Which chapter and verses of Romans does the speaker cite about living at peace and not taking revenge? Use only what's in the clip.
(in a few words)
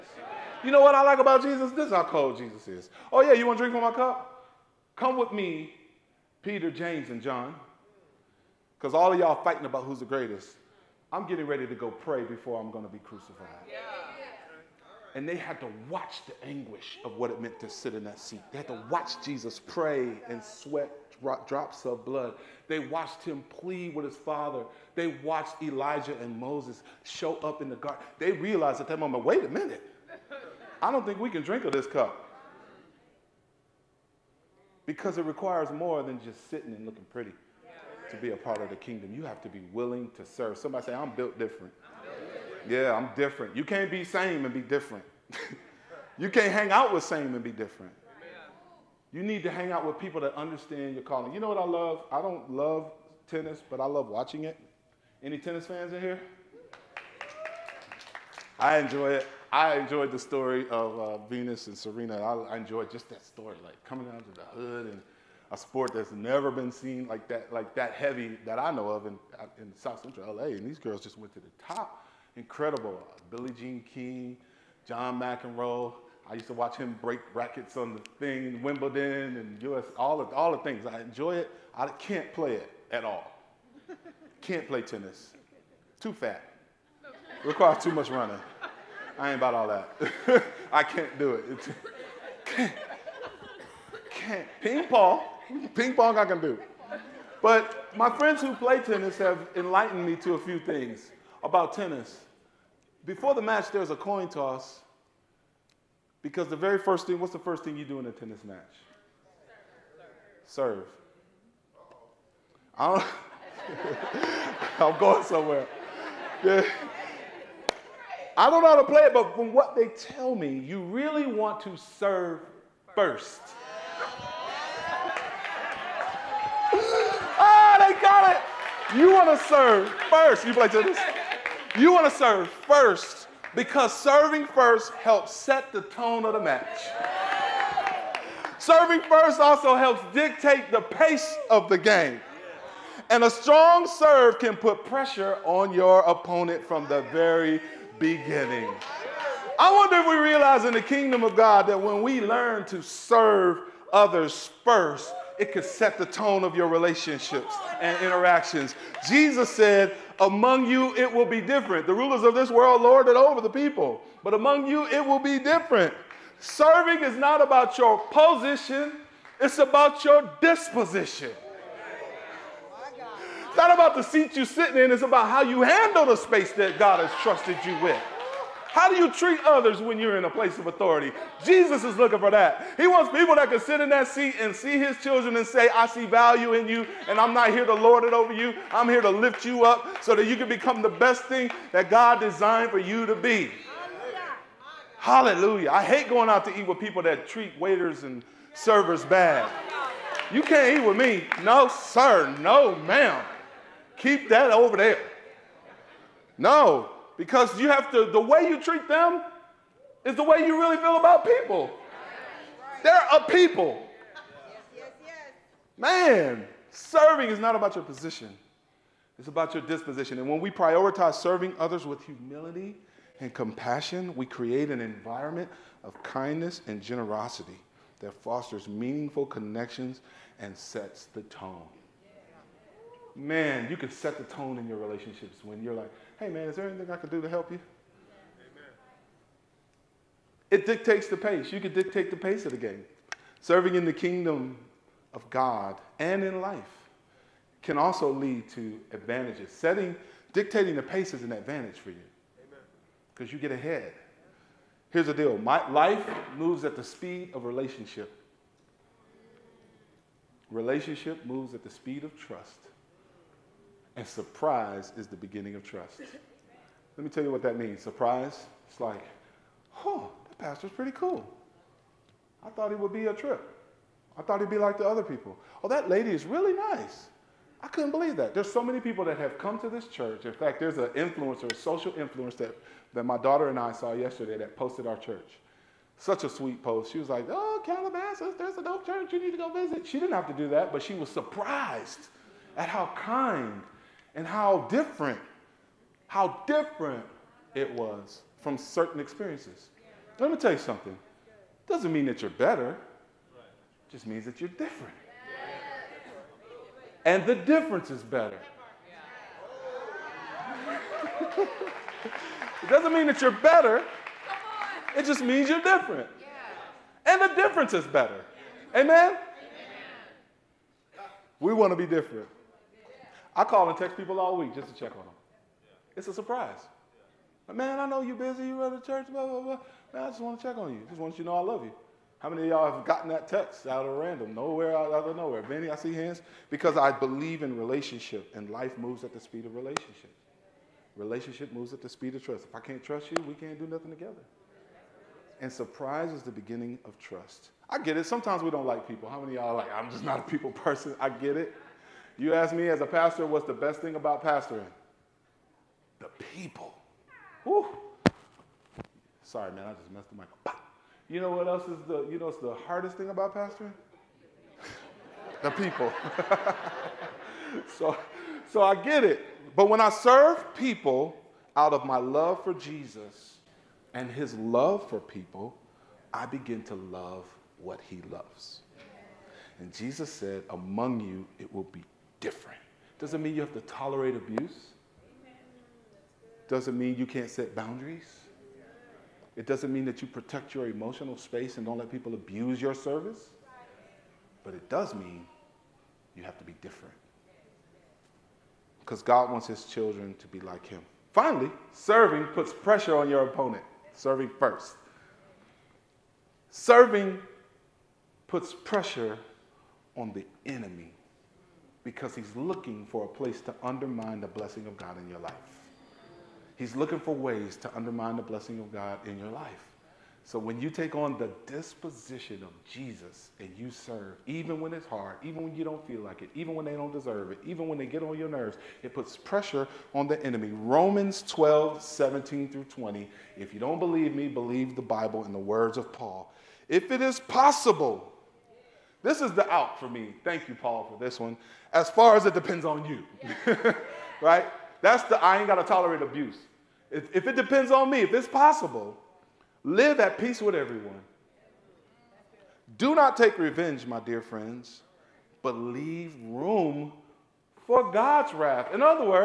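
Romans 12:17-20.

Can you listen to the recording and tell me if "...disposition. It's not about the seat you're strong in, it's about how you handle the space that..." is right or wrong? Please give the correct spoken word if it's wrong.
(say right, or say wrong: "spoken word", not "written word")
wrong: "sitting", not "strong".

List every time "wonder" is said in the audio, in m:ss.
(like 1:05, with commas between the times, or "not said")
2:29.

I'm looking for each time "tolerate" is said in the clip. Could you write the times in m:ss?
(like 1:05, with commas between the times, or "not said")
6:23, 7:25.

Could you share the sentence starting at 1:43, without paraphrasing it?
Before the match, there's a coin toss because the very first thing, what's the first thing you do in a tennis match?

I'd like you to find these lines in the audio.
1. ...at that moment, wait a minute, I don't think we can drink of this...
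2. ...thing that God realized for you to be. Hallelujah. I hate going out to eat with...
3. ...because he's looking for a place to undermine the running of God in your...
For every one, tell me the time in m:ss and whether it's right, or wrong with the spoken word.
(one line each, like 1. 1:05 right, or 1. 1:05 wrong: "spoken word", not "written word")
1. 0:28 right
2. 3:11 wrong: "designed", not "realized"
3. 6:51 wrong: "blessing", not "running".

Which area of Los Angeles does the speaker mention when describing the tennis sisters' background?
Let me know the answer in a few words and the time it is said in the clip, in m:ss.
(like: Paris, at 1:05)
South Central LA, at 1:09.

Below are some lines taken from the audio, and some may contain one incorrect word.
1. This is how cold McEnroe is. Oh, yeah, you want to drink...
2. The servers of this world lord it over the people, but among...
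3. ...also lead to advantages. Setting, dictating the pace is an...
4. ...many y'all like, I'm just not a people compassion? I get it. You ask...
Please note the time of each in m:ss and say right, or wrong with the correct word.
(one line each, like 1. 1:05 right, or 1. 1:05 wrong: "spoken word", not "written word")
1. 0:01 wrong: "Jesus", not "McEnroe"
2. 2:41 wrong: "rulers", not "servers"
3. 4:07 right
4. 5:49 wrong: "person", not "compassion".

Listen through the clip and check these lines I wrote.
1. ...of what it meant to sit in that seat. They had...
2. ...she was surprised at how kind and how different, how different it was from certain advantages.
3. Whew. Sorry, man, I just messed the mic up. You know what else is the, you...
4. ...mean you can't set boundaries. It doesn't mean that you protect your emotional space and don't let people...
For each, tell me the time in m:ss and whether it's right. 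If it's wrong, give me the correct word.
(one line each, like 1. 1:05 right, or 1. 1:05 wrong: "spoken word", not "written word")
1. 0:17 right
2. 4:50 wrong: "experiences", not "advantages"
3. 5:57 right
4. 6:26 right.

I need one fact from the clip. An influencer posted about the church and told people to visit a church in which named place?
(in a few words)
Calabasas.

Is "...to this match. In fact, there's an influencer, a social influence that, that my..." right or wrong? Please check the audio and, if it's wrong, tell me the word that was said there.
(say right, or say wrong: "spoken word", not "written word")
wrong: "church", not "match".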